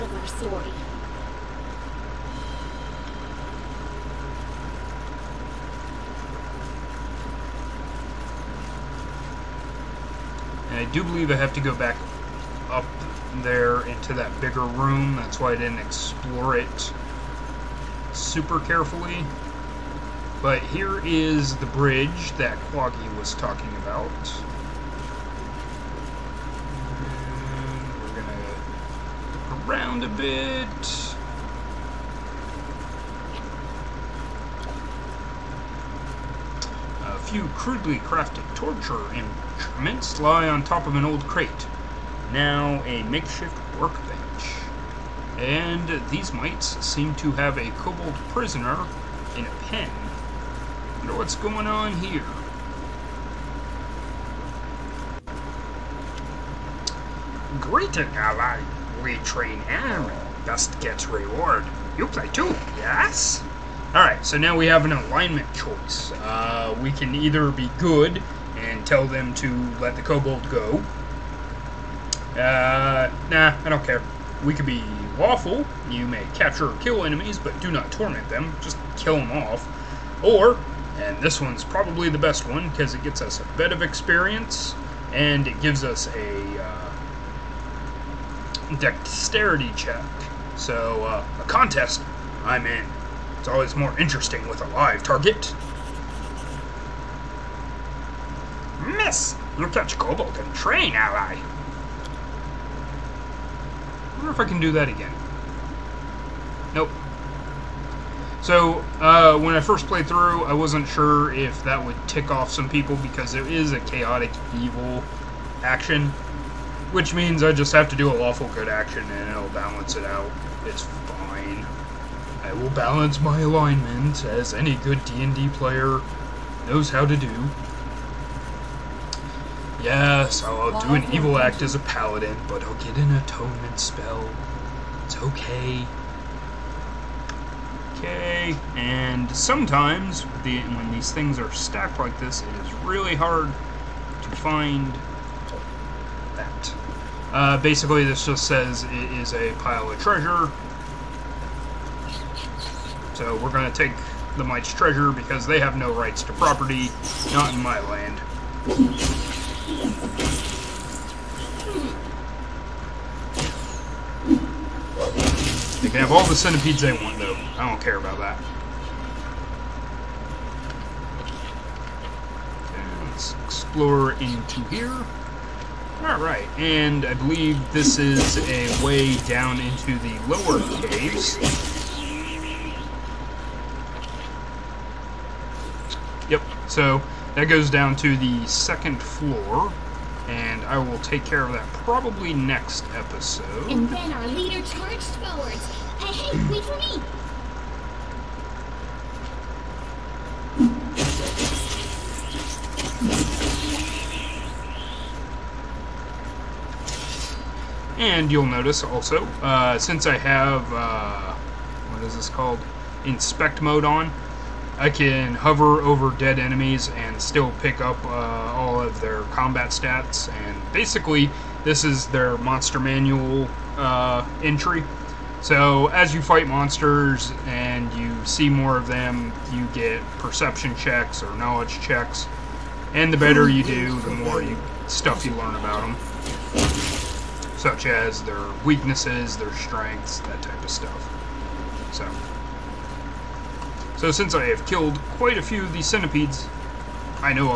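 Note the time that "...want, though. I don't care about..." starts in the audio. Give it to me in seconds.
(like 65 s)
166 s.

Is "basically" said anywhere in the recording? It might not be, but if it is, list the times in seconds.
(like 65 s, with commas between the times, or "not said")
147 s, 220 s.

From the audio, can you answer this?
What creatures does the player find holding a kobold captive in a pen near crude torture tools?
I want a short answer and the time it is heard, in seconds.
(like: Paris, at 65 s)
Mites, at 46 s.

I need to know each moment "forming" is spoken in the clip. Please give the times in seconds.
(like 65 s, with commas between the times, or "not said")
not said.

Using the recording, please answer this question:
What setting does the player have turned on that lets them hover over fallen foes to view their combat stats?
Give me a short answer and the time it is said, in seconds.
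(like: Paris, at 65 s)
Inspect mode, at 213 s.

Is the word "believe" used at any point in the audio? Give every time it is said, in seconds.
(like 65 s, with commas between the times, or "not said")
11 s, 177 s.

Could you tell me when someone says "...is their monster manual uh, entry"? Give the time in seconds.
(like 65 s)
221 s.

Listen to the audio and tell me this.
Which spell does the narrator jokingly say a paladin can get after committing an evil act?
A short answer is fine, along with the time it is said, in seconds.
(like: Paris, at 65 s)
Atonement, at 133 s.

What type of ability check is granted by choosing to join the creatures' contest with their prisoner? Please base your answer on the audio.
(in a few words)
Dexterity check.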